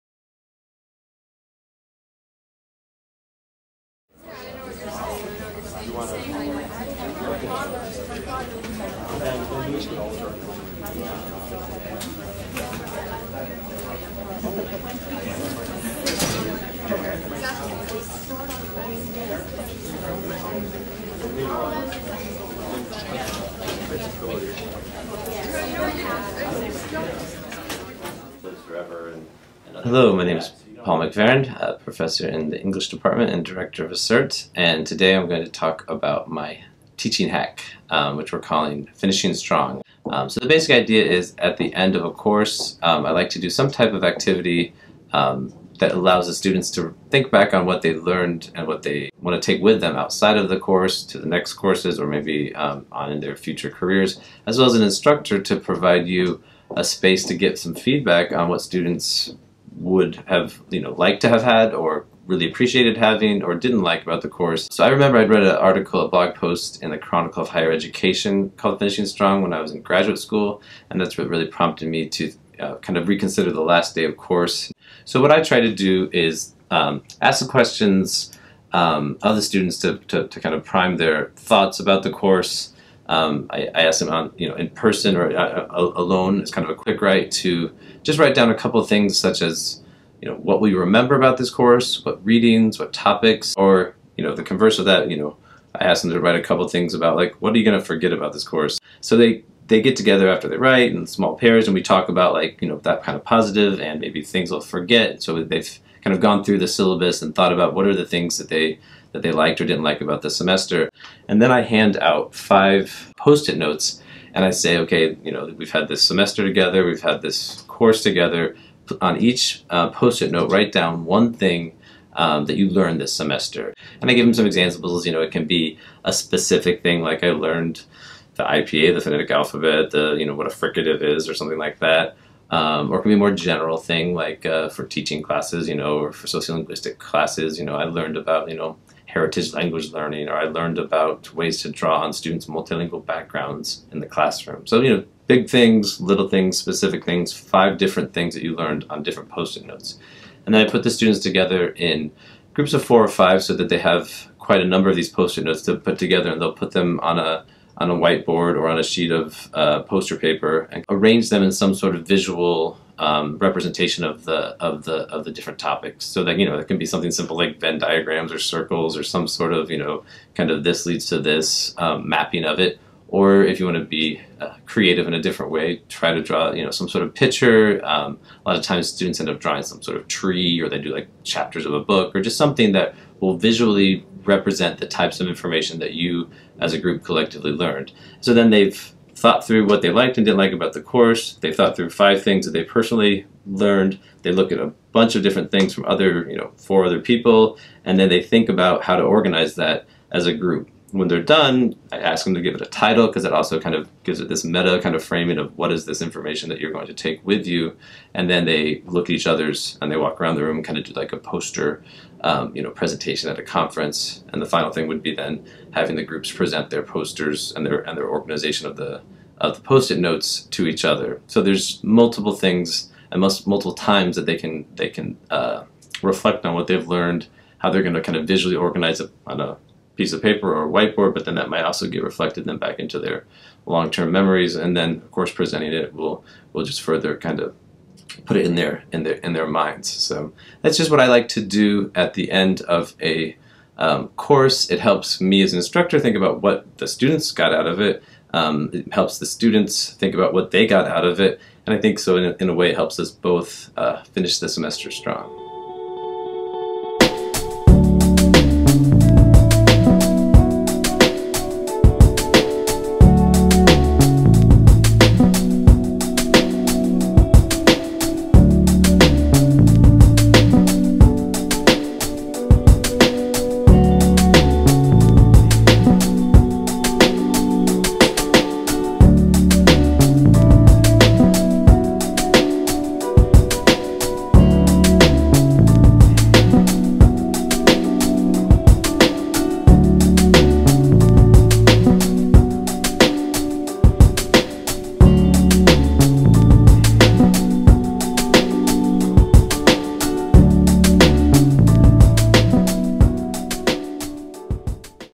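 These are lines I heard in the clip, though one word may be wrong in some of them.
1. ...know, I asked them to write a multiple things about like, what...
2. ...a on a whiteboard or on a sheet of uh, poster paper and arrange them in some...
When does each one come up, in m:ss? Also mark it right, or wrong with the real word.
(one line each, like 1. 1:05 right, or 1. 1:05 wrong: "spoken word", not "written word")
1. 1:35 wrong: "couple", not "multiple"
2. 2:37 right.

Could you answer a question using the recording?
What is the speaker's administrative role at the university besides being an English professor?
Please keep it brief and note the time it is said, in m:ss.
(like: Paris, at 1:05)
director of ACERT, at 0:33.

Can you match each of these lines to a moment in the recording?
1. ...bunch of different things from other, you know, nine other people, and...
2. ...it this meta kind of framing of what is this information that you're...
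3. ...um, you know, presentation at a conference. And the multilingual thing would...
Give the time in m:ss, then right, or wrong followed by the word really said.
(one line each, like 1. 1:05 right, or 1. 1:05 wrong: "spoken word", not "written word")
1. 3:14 wrong: "four", not "nine"
2. 3:24 right
3. 3:32 wrong: "final", not "multilingual".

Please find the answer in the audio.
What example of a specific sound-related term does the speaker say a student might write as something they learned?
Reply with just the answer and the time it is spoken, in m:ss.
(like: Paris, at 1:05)
fricative, at 2:10.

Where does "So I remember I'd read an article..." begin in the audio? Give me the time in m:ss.
1:04.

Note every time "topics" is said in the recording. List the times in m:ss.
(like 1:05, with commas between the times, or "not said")
1:32, 2:45.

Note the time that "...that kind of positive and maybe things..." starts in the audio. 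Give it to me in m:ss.
1:42.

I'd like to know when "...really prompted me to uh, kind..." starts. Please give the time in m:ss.
1:11.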